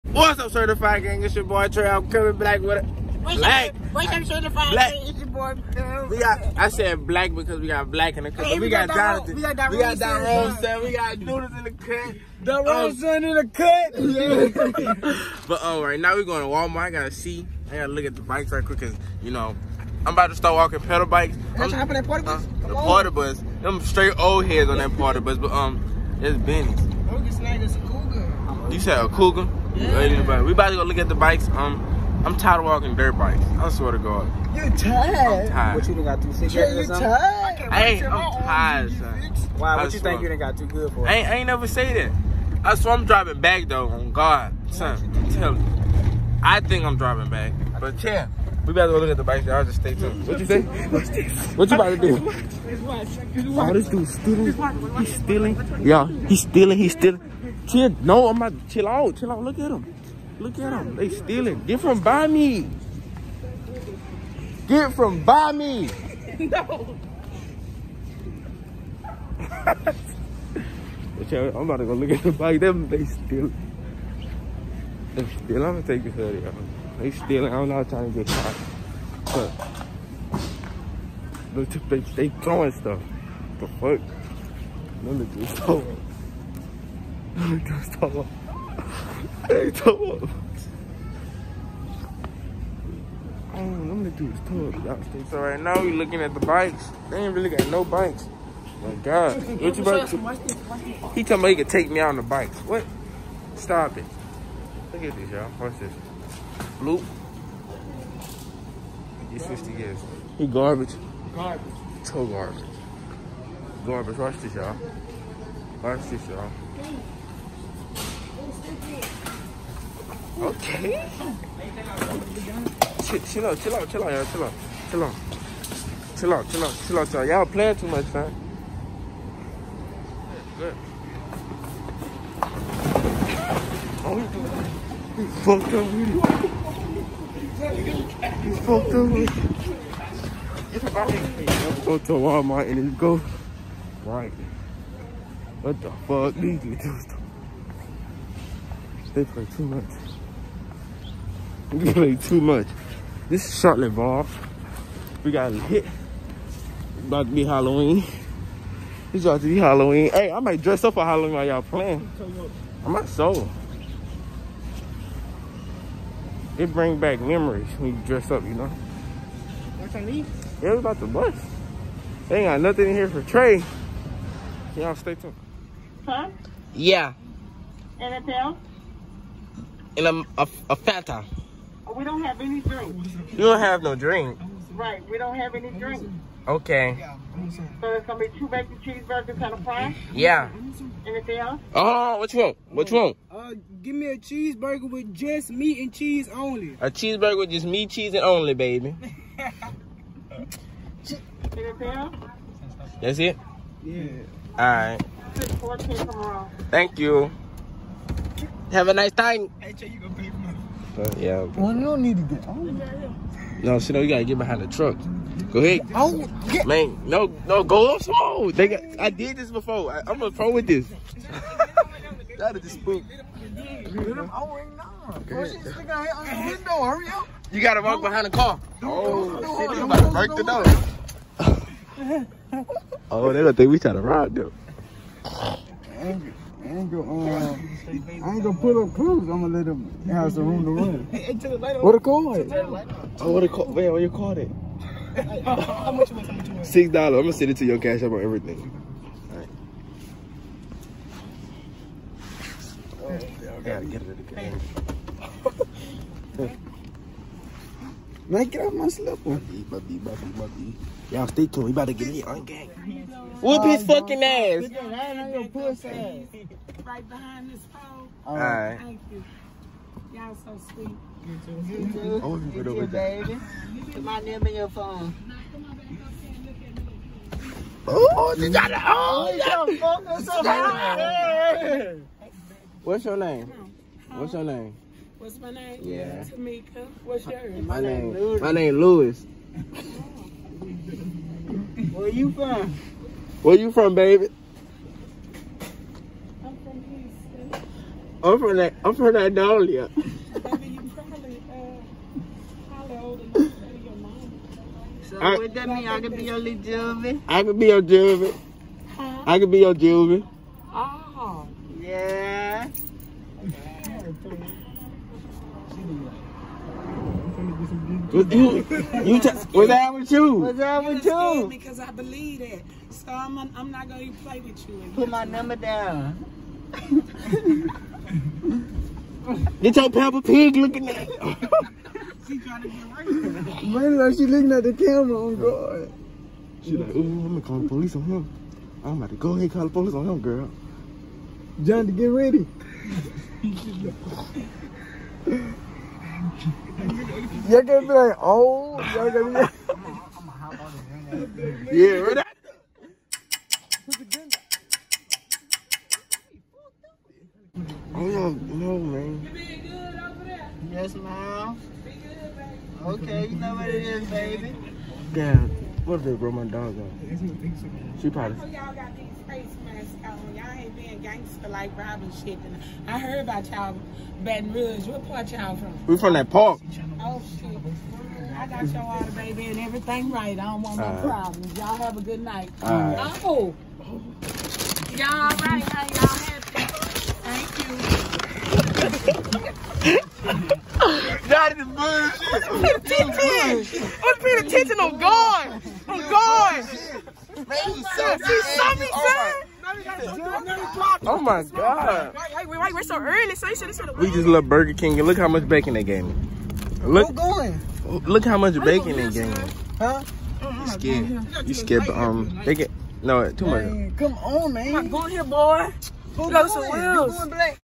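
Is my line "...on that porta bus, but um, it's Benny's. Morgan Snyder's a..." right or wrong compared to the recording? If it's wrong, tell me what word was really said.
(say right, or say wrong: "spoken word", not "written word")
right.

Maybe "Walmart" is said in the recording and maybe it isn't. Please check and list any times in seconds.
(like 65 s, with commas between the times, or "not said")
16 s, 142 s.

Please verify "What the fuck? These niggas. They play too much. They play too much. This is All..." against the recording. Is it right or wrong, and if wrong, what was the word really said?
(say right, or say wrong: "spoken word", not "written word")
wrong: "Charlotte", not "All".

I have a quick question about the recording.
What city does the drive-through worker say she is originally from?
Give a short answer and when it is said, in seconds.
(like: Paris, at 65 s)
Houston, at 296 s.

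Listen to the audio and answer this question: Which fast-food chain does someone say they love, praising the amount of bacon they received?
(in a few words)
Burger King.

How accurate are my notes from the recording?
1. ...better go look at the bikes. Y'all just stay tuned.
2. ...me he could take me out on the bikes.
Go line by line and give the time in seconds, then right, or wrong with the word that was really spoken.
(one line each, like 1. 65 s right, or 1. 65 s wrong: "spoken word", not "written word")
1. 48 s right
2. 101 s right.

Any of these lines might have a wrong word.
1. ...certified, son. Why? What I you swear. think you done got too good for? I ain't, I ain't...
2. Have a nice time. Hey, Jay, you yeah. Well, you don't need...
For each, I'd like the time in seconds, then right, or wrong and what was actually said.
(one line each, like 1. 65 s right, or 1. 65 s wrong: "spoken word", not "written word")
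1. 38 s wrong: "tired", not "certified"
2. 208 s right.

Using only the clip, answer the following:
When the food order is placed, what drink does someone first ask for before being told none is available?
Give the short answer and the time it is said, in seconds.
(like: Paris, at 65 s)
Fanta, at 180 s.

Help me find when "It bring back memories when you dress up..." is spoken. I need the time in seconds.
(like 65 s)
166 s.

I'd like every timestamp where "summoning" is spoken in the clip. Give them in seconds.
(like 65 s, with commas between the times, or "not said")
not said.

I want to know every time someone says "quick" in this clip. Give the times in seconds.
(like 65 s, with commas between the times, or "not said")
18 s.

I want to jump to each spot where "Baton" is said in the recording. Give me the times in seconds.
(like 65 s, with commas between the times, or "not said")
374 s.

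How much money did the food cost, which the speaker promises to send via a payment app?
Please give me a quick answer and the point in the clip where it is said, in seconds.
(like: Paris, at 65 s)
$6, at 246 s.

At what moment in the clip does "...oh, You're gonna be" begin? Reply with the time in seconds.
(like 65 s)
348 s.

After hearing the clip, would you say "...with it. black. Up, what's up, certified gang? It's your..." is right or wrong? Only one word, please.
right.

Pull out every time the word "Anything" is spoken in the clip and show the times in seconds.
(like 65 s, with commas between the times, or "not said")
177 s, 191 s.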